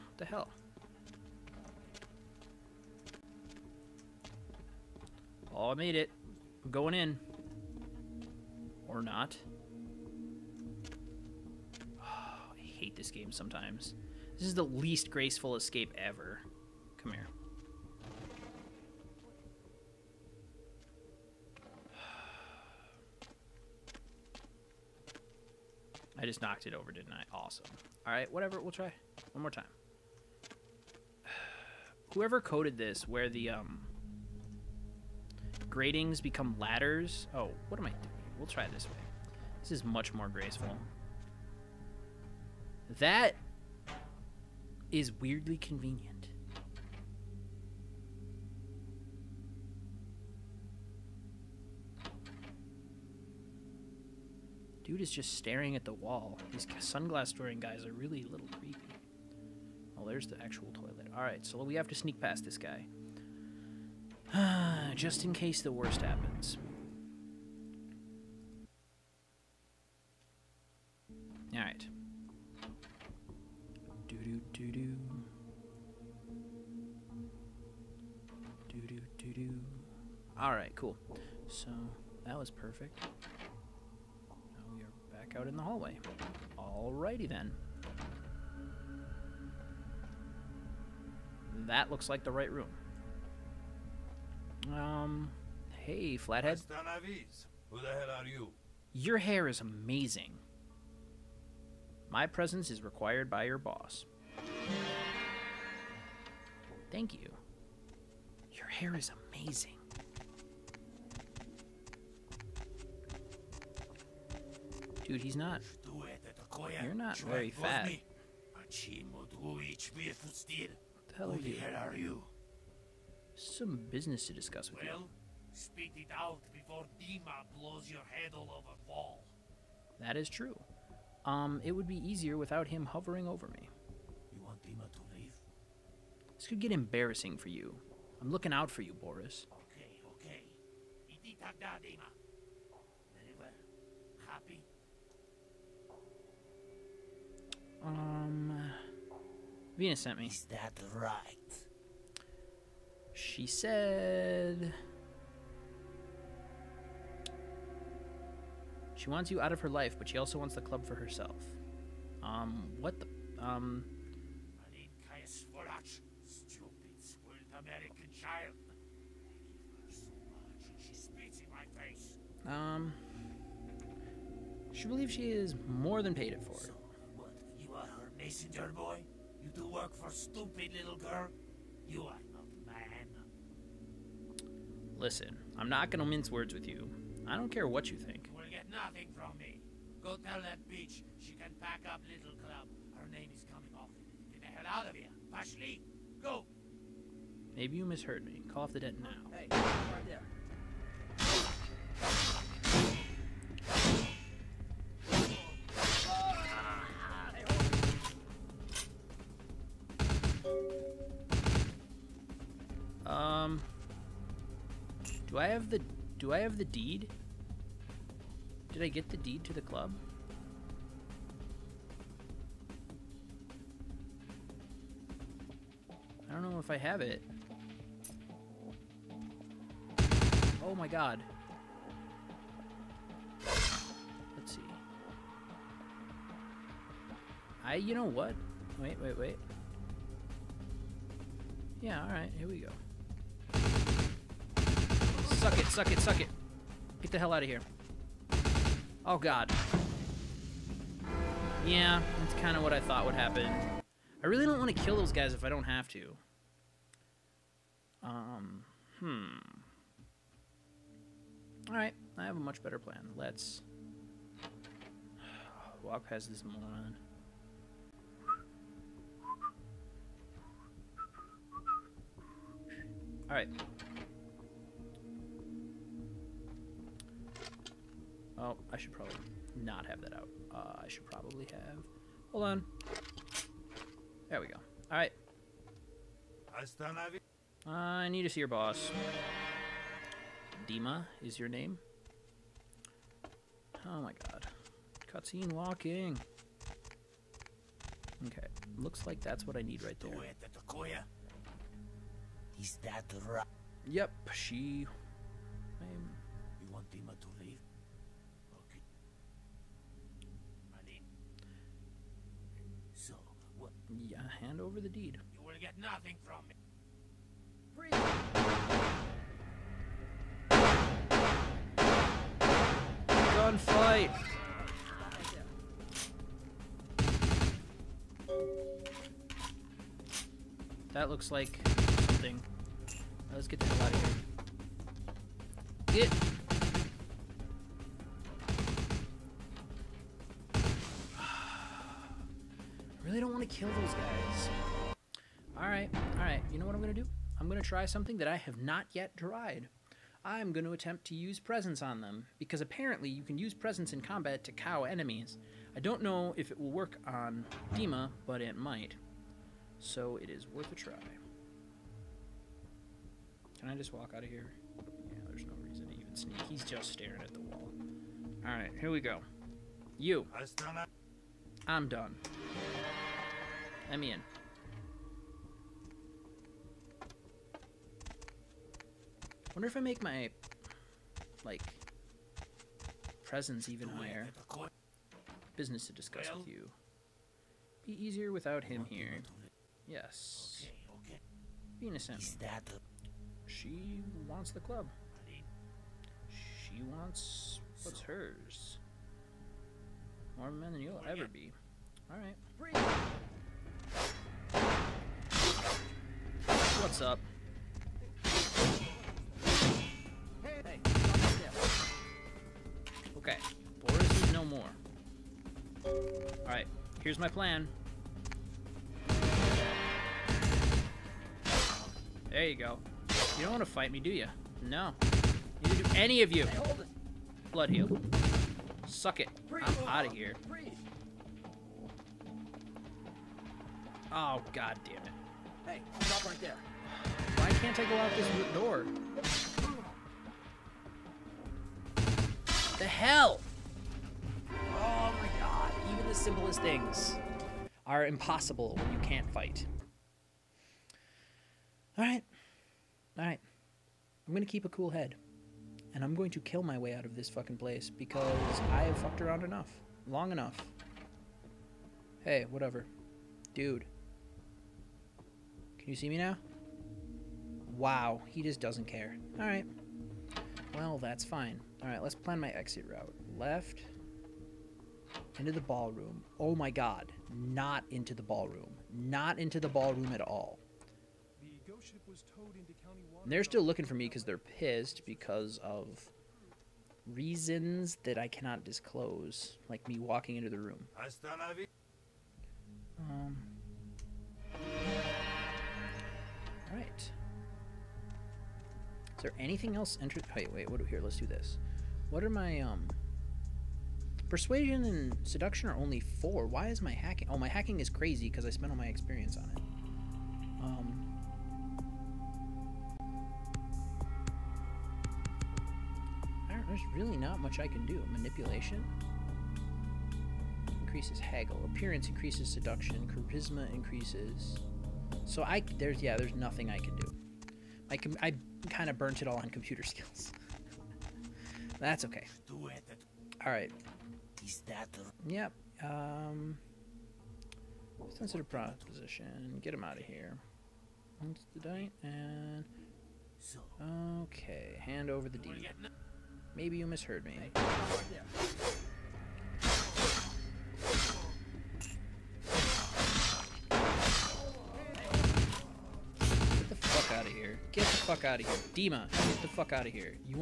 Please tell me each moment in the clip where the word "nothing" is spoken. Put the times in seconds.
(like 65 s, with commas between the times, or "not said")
188 s, 315 s, 526 s.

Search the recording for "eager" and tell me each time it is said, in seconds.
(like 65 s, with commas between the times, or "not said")
not said.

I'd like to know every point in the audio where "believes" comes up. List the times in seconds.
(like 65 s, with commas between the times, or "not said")
174 s.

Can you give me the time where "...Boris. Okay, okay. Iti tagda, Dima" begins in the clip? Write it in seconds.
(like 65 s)
138 s.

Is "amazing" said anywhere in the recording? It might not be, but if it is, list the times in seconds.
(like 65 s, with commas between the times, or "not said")
99 s, 109 s.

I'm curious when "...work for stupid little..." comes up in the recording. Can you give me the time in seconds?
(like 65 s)
179 s.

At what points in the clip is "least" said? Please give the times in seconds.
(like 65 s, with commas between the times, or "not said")
14 s.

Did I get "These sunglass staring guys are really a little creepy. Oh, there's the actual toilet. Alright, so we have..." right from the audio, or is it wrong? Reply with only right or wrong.
wrong.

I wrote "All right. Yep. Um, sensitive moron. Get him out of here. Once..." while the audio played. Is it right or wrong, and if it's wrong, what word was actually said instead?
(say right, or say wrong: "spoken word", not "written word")
wrong: "proposition", not "moron".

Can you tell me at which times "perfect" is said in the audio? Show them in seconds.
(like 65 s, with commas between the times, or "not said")
82 s.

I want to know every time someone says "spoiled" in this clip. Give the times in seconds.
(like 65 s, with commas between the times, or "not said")
166 s.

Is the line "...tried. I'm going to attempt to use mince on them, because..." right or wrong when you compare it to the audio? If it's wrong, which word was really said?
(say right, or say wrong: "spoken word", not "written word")
wrong: "presence", not "mince".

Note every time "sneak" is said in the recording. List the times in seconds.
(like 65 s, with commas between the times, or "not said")
61 s, 366 s.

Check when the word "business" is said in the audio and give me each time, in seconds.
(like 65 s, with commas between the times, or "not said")
123 s, 385 s.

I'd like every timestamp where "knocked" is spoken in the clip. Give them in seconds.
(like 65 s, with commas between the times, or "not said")
26 s.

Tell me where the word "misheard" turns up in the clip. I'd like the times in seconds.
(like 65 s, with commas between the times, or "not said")
197 s, 546 s.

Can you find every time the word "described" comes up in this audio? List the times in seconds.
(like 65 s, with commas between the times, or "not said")
not said.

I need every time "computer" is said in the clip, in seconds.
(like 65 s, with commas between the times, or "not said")
529 s.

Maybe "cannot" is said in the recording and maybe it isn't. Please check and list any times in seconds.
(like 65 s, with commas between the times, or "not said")
488 s.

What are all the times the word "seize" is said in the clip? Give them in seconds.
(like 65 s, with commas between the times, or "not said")
not said.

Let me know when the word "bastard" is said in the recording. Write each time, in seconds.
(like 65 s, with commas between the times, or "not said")
not said.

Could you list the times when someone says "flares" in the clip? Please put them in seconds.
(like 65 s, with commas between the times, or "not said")
not said.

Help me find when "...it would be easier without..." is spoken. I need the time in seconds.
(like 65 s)
131 s.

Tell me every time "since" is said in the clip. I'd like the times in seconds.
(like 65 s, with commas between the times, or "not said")
not said.